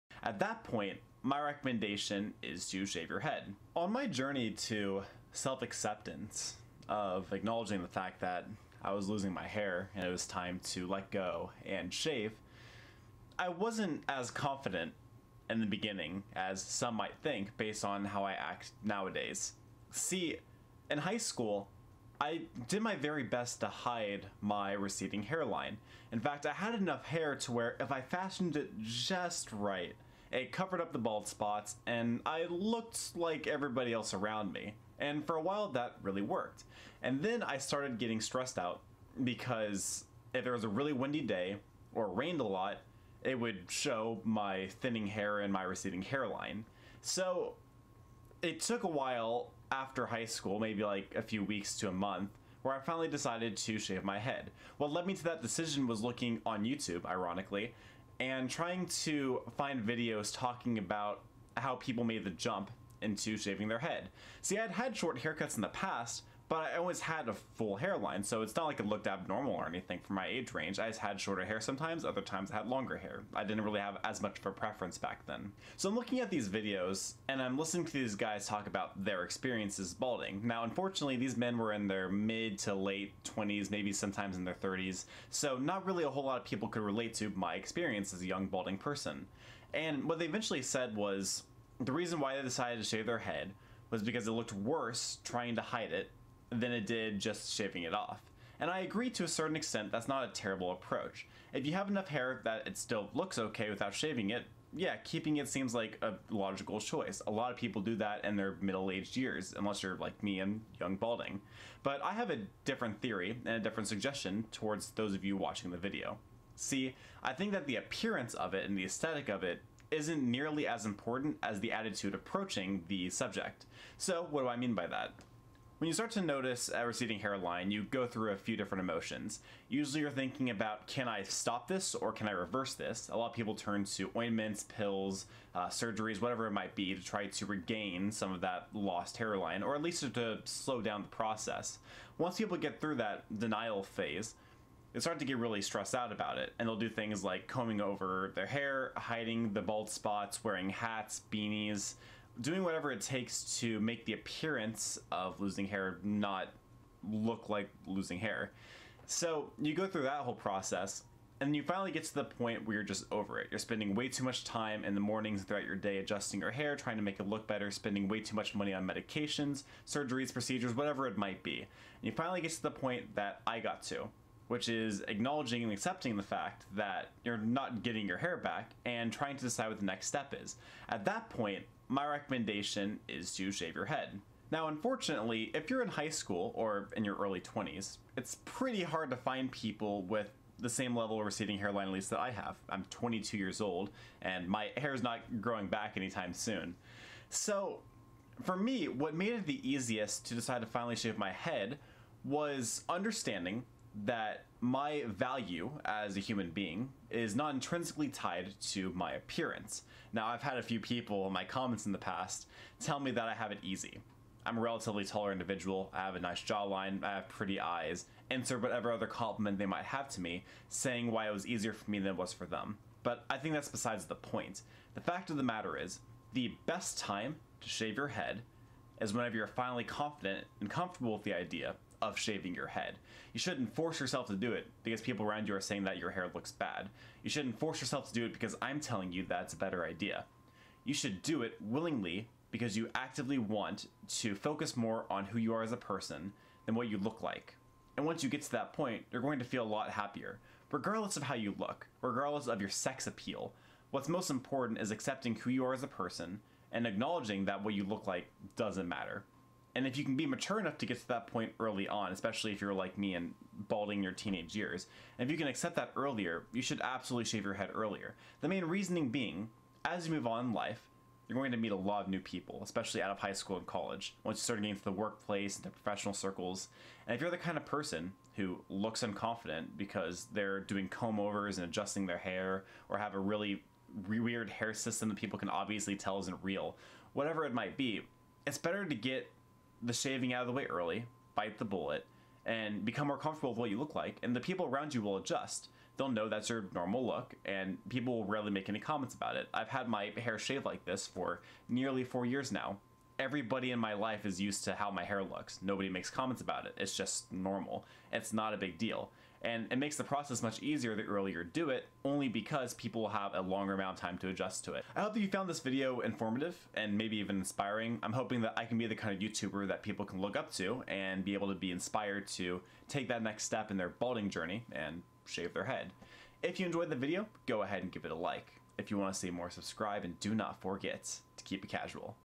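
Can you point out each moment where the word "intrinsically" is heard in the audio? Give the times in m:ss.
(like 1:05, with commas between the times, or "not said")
3:27.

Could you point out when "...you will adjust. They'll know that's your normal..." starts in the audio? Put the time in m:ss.
4:54.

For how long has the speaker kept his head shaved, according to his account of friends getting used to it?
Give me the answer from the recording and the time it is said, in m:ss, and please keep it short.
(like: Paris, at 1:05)
Nearly four years, at 5:01.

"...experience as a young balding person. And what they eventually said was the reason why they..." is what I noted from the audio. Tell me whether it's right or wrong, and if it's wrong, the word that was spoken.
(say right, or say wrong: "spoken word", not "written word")
right.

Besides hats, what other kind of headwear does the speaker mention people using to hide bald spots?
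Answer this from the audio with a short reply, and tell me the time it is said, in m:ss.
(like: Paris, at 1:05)
Beanies, at 2:31.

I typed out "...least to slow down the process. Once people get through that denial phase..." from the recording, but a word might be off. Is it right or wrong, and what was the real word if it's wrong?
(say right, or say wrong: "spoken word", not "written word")
right.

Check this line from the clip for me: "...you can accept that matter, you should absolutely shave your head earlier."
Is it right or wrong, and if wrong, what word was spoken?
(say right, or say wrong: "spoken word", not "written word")
wrong: "earlier", not "matter".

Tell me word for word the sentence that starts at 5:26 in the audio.
If you enjoyed the video, go ahead and give it a like.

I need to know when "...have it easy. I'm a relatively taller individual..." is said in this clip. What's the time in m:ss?
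3:33.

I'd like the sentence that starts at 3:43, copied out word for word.
But I think that's besides the point.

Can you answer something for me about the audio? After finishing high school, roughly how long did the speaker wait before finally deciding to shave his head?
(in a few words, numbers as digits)
A few weeks to a month.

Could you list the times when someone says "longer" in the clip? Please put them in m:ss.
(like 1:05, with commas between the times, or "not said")
1:12, 5:13.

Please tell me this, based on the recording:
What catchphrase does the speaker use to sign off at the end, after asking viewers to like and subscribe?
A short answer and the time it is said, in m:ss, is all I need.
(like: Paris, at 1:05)
Keep it casual, at 5:31.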